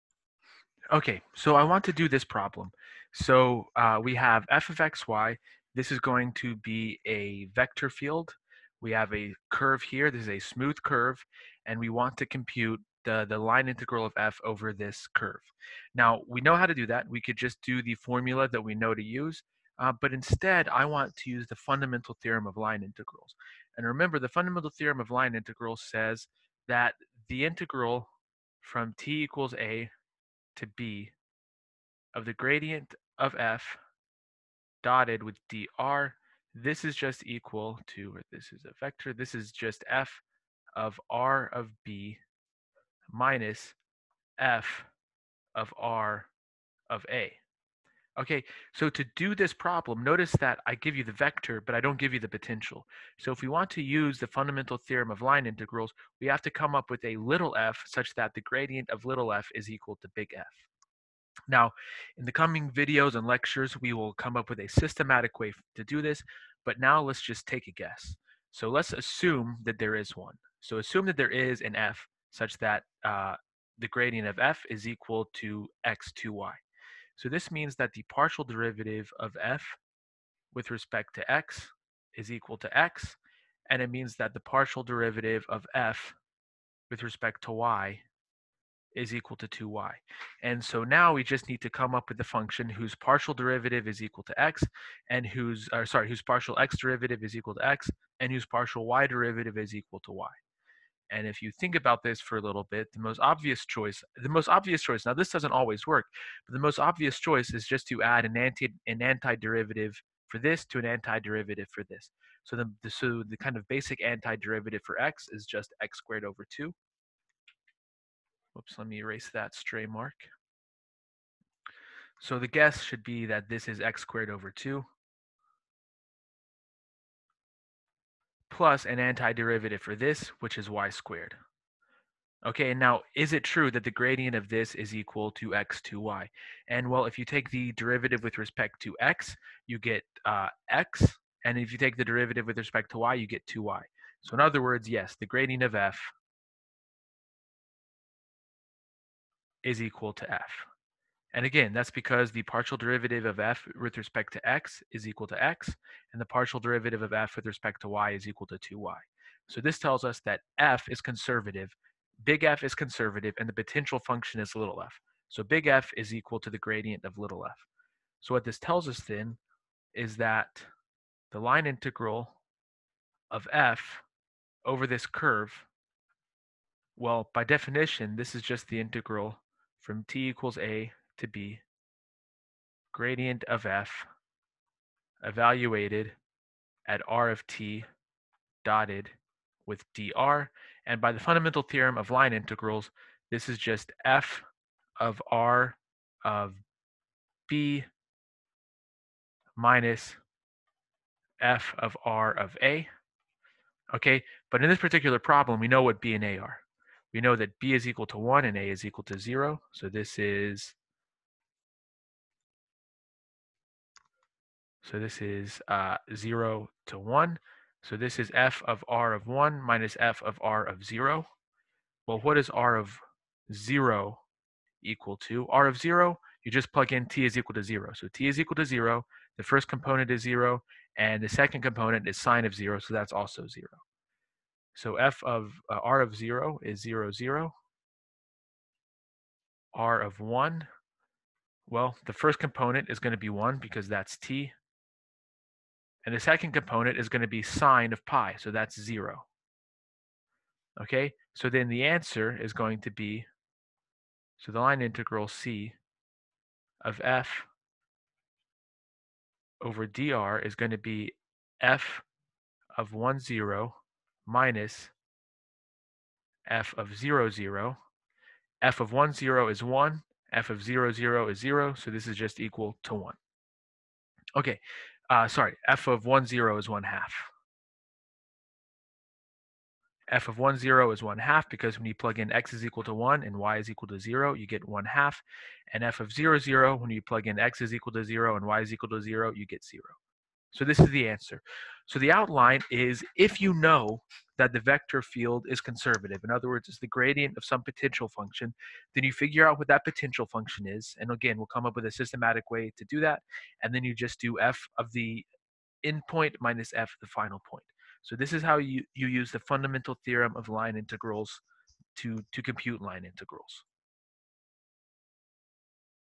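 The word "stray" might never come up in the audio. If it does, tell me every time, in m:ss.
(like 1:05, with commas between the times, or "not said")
1:59.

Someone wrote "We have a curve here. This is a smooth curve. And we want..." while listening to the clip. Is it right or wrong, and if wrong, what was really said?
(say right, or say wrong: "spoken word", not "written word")
right.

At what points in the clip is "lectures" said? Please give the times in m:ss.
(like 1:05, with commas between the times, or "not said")
1:03.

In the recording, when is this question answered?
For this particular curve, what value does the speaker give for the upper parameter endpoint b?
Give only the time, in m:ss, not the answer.
3:27.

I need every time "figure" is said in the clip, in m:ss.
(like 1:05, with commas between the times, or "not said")
4:59.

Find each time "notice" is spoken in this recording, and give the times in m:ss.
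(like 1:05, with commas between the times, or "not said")
0:50.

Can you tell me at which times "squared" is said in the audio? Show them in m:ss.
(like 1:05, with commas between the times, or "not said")
1:55, 2:04, 2:10.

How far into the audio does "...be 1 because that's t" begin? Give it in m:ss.
4:03.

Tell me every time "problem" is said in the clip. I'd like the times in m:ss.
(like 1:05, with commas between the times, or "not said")
0:02, 0:49, 3:25.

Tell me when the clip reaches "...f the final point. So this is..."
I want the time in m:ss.
5:06.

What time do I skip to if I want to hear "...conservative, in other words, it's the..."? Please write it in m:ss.
4:55.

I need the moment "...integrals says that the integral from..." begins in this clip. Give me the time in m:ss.
0:25.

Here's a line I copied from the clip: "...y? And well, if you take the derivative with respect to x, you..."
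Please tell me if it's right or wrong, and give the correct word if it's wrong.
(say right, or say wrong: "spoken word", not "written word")
right.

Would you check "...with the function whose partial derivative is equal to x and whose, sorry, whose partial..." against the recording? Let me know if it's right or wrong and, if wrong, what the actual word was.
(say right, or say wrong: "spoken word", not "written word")
right.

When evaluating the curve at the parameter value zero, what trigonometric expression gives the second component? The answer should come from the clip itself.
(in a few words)
sine of 0.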